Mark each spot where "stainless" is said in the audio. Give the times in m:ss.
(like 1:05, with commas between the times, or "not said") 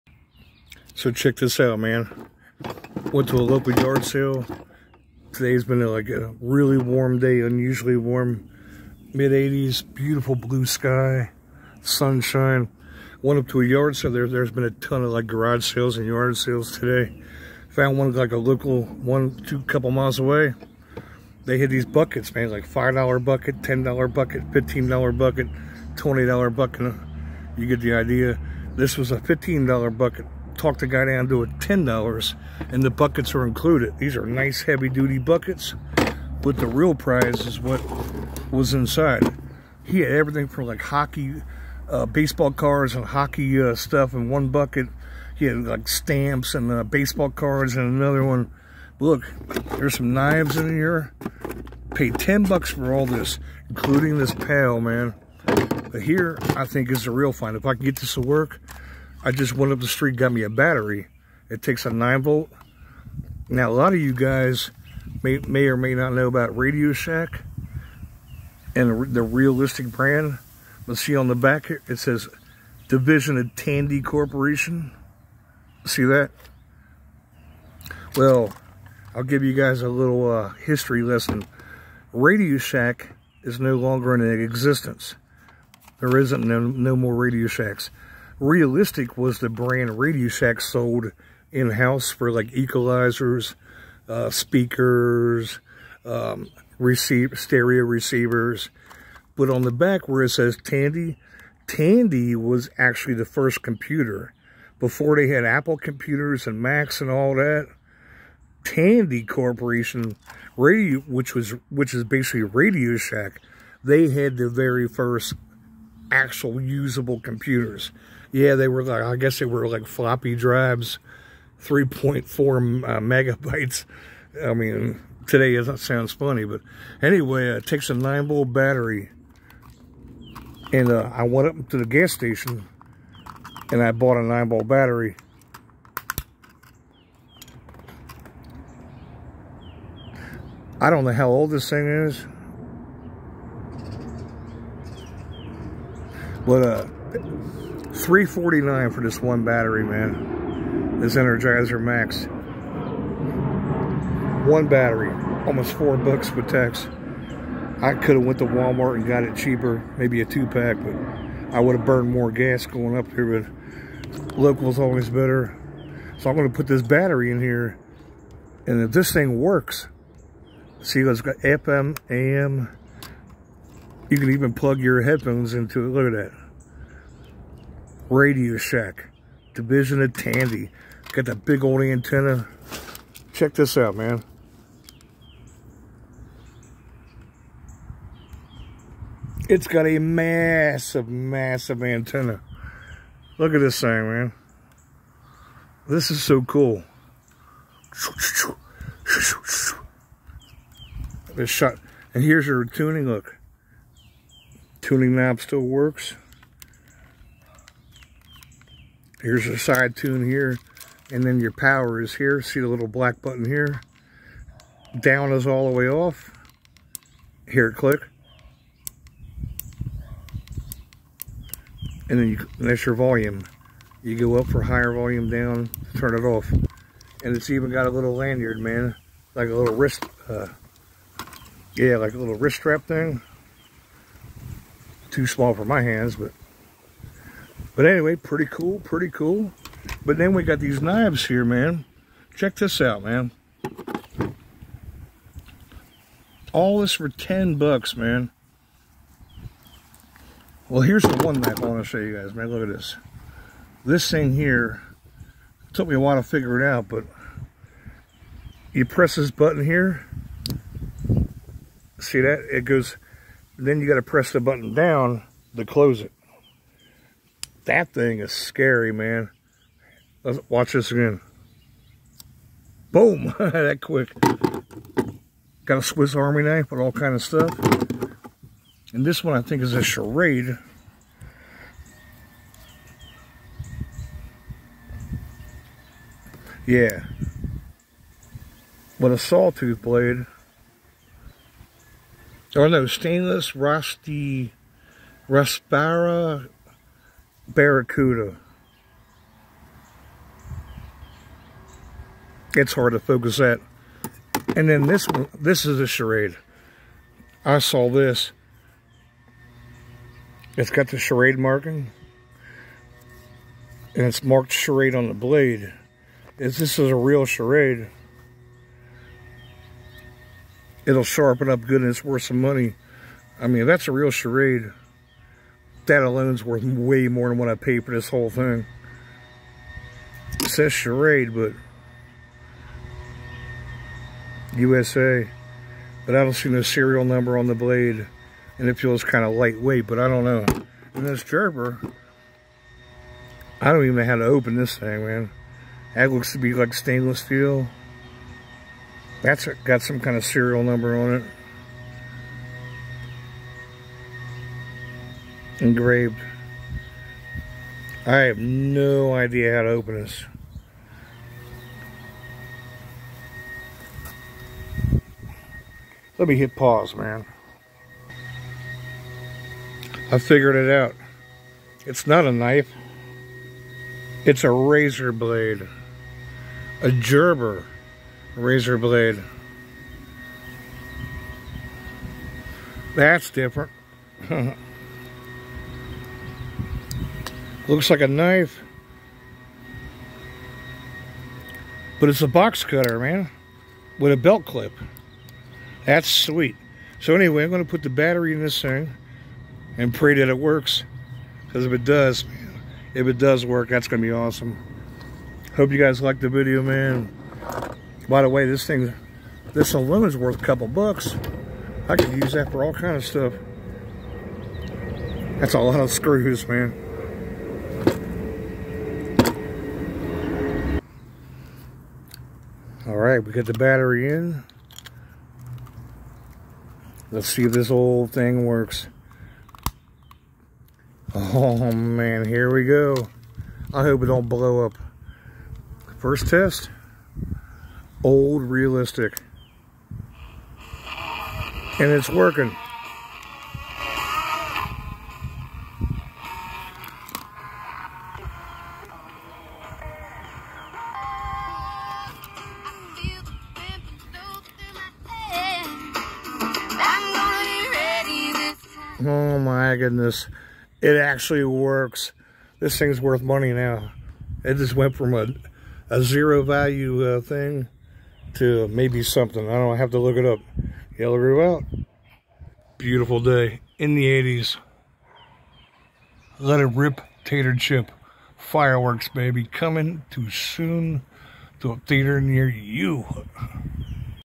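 4:52, 5:46.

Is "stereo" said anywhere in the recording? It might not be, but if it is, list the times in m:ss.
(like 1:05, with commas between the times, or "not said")
1:37.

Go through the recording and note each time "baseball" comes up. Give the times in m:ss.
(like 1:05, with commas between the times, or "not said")
0:42, 0:46.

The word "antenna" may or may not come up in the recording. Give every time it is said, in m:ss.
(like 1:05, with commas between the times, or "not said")
3:01, 3:11.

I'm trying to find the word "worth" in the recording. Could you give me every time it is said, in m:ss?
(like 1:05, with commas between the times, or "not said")
5:22, 5:26, 6:50, 7:43.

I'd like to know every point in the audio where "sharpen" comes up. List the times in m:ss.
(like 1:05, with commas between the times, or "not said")
5:21.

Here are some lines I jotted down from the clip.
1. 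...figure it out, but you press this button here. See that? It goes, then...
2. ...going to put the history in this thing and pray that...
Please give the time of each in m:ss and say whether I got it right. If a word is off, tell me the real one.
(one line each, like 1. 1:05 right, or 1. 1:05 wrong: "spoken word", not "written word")
1. 4:16 right
2. 6:37 wrong: "battery", not "history".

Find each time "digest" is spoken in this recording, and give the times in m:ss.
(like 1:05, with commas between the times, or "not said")
not said.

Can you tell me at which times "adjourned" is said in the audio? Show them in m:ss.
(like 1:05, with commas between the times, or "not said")
not said.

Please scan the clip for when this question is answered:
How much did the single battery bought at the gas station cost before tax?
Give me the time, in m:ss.
2:28.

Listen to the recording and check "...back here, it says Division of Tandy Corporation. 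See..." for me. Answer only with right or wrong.
right.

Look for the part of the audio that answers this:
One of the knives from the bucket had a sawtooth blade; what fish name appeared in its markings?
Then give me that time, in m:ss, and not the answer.
4:57.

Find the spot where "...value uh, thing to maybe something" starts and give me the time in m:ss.
7:46.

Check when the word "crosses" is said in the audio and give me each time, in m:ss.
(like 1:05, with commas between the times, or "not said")
not said.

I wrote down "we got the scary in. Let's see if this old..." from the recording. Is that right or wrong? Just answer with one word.
wrong.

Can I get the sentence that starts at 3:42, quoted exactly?
And then you, and that's your volume.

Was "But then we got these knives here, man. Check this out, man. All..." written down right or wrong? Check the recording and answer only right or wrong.
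right.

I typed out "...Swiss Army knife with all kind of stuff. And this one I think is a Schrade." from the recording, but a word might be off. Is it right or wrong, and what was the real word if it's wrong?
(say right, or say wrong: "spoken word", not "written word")
right.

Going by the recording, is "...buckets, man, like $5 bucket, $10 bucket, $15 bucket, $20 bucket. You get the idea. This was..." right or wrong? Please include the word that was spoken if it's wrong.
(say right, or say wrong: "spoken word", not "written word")
right.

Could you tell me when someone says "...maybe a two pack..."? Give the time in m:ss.
2:39.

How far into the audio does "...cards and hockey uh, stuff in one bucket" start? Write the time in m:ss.
0:42.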